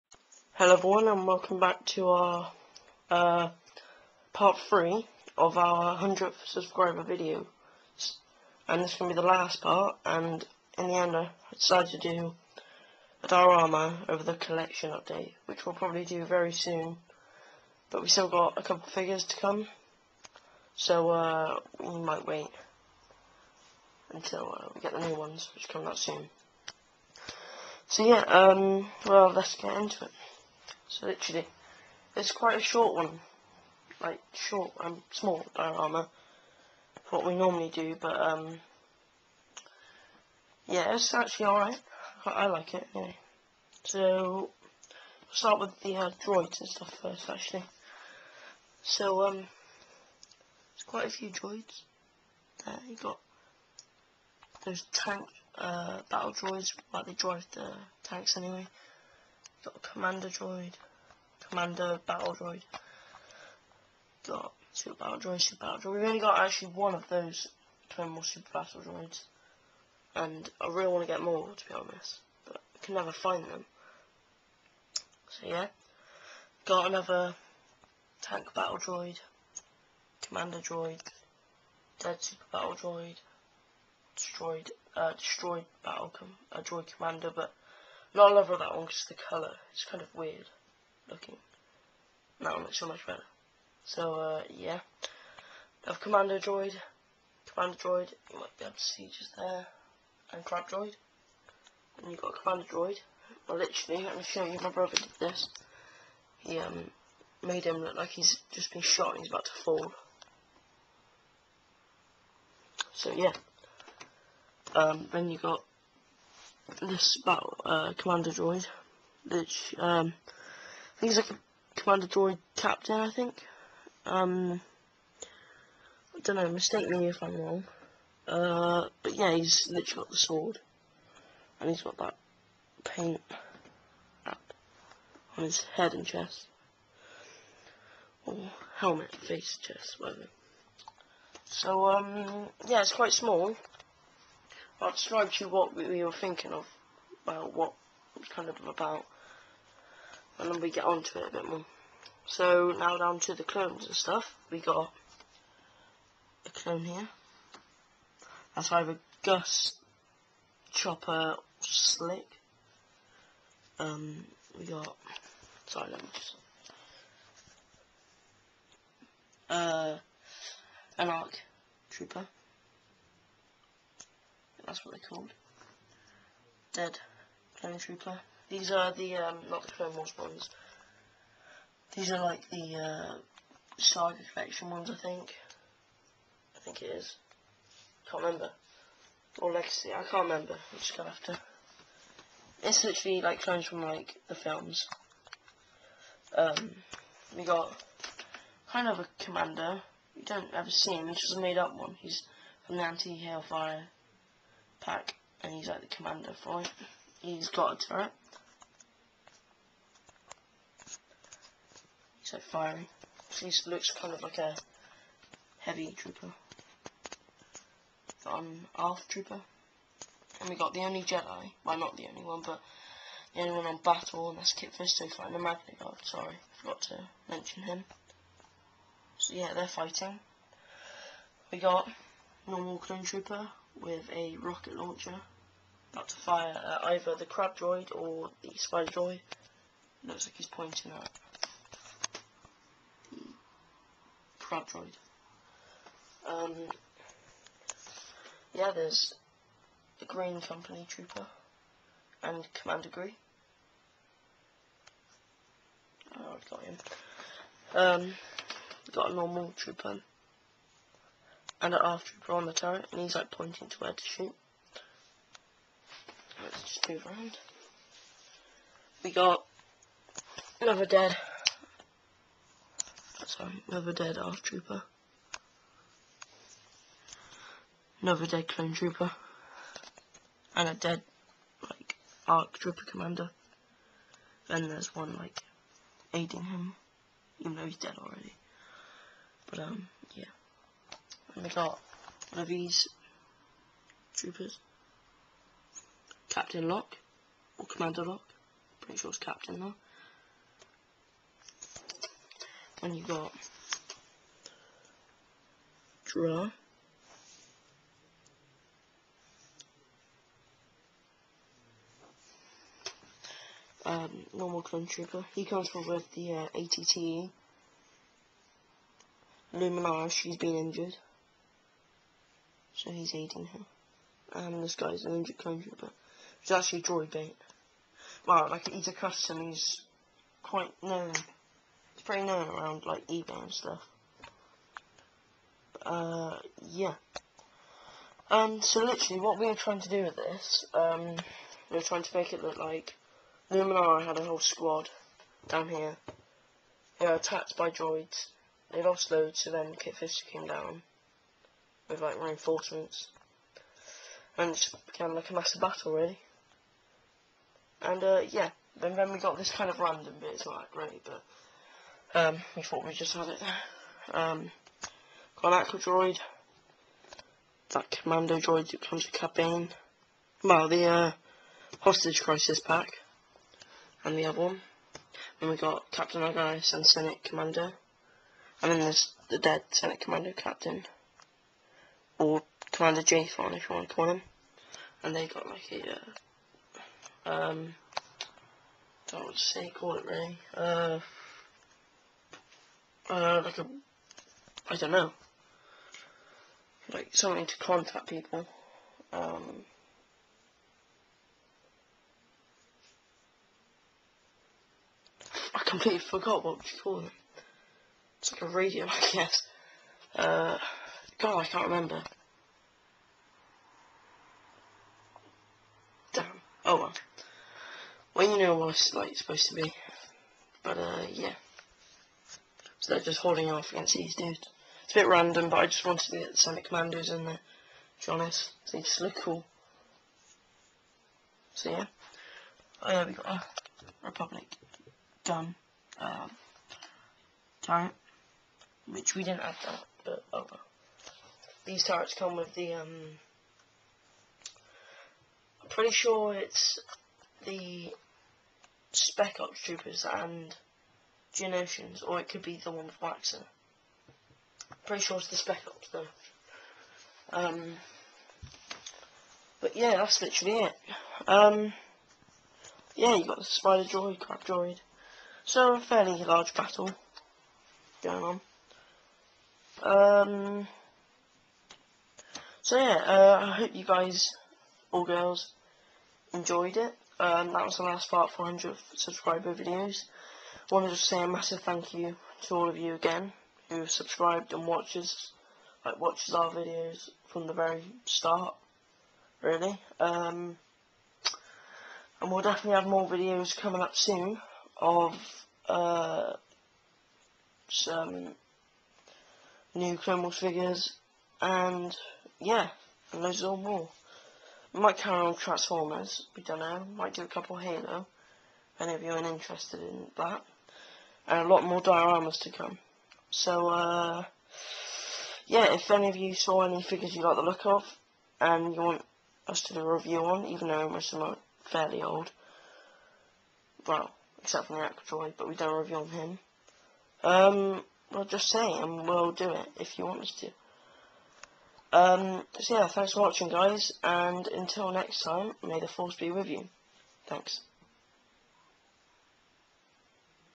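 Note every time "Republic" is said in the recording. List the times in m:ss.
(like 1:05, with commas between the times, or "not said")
7:14.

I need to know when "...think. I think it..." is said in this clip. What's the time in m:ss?
3:04.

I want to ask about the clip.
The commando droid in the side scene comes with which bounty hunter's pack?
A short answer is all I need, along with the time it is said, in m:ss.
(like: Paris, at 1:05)
Cad Bane, at 6:09.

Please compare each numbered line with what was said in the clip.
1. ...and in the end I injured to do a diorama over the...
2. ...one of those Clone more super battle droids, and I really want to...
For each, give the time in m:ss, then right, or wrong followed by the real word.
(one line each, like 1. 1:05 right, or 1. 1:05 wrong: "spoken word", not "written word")
1. 0:10 wrong: "decided", not "injured"
2. 1:06 right.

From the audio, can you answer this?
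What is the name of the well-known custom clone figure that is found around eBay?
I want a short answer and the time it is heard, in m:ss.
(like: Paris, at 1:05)
Droid Bait, at 5:26.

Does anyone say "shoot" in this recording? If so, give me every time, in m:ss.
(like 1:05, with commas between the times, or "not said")
4:24.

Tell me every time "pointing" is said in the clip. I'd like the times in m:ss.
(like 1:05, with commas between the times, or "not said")
4:00, 4:23.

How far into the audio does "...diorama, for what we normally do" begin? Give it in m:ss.
0:35.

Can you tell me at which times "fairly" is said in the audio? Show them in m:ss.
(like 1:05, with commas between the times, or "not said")
7:45, 8:41.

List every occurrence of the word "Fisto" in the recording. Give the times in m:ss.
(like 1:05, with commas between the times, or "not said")
3:44, 5:49.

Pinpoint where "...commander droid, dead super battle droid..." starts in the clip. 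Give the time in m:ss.
1:20.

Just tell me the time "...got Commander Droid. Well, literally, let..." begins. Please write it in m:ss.
1:42.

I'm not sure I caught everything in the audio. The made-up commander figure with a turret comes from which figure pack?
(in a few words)
anti-Hailfire pack.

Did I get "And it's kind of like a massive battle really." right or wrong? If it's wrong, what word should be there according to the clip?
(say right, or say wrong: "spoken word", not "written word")
right.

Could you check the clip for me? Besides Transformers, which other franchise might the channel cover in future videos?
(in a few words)
Halo.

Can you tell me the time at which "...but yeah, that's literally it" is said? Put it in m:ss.
7:39.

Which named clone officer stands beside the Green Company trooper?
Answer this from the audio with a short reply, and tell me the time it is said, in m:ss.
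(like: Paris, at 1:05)
Commander Gree, at 4:12.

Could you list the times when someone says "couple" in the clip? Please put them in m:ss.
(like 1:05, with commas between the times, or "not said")
0:18, 8:27.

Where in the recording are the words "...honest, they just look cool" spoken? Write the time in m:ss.
7:08.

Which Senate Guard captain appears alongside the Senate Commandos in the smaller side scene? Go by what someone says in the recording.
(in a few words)
Captain Argyus.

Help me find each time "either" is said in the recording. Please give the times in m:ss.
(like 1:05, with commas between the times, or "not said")
2:38, 3:56.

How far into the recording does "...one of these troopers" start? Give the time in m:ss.
4:52.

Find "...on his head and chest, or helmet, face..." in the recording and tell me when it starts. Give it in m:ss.
2:15.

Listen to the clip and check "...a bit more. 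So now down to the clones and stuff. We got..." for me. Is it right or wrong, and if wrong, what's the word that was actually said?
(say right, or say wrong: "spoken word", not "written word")
right.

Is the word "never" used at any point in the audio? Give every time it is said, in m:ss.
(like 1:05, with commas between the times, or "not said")
1:12.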